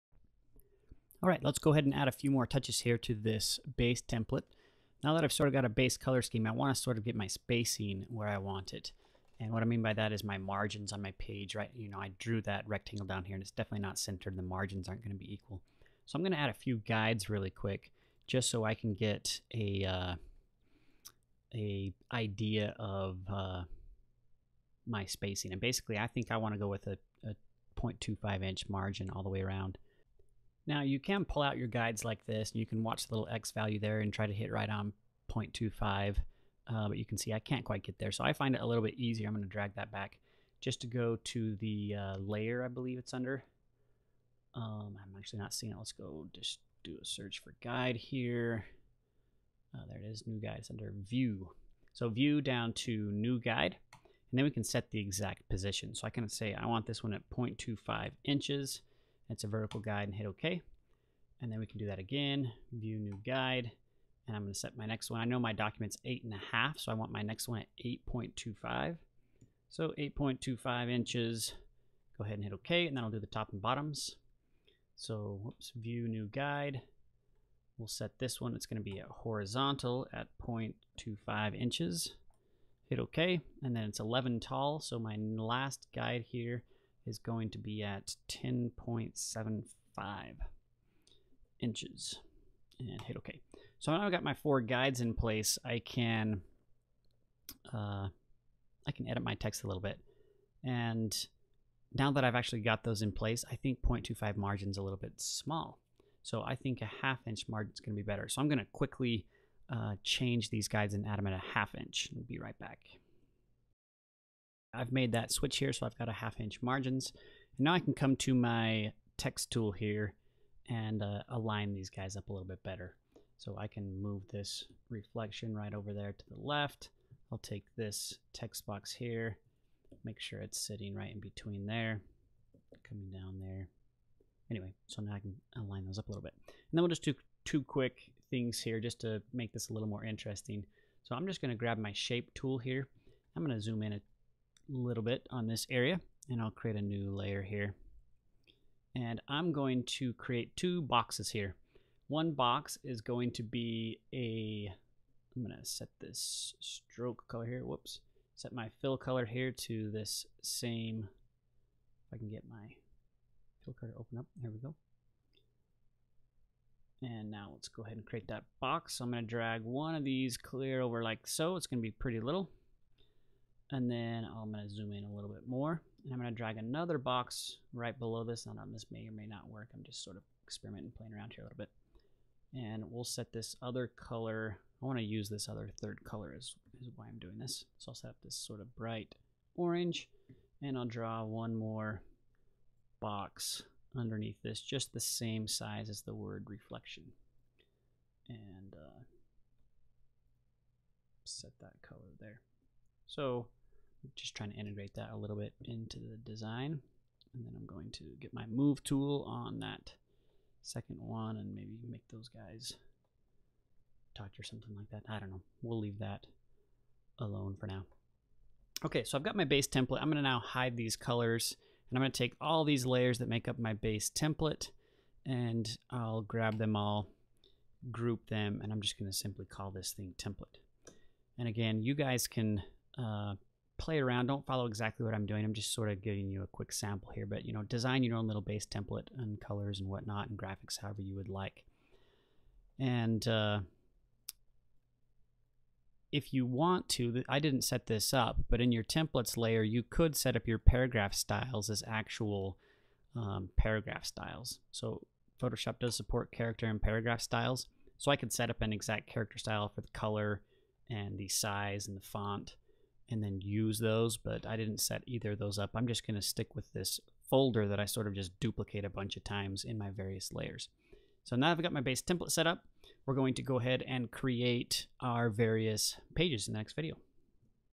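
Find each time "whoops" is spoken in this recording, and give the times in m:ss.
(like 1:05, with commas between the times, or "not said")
1:15, 2:37.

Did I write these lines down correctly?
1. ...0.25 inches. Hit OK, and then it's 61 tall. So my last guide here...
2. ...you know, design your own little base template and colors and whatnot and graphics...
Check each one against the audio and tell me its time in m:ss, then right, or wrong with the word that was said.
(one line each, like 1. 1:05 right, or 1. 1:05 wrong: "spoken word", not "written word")
1. 1:20 wrong: "11", not "61"
2. 3:57 right.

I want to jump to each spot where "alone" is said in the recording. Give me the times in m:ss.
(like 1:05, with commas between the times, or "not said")
3:37.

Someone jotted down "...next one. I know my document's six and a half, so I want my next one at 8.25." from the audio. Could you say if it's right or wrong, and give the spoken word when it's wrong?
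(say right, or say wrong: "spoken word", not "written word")
wrong: "eight", not "six".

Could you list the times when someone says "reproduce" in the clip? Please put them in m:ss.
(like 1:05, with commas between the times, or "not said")
not said.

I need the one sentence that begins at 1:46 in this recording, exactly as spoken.
So I think a half inch margin's gonna be better.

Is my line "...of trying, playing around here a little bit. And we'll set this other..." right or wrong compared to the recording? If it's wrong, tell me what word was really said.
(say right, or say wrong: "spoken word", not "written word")
wrong: "experimenting", not "trying".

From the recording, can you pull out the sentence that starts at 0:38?
So I find it a little bit easier.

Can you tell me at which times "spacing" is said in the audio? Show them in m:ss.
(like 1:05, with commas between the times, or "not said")
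0:07, 0:25.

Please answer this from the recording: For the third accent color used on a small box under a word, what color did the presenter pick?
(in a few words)
bright orange.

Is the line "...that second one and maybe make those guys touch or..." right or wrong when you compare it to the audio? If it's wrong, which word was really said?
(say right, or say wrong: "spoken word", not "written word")
right.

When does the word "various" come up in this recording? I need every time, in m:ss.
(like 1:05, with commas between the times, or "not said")
4:29, 4:35.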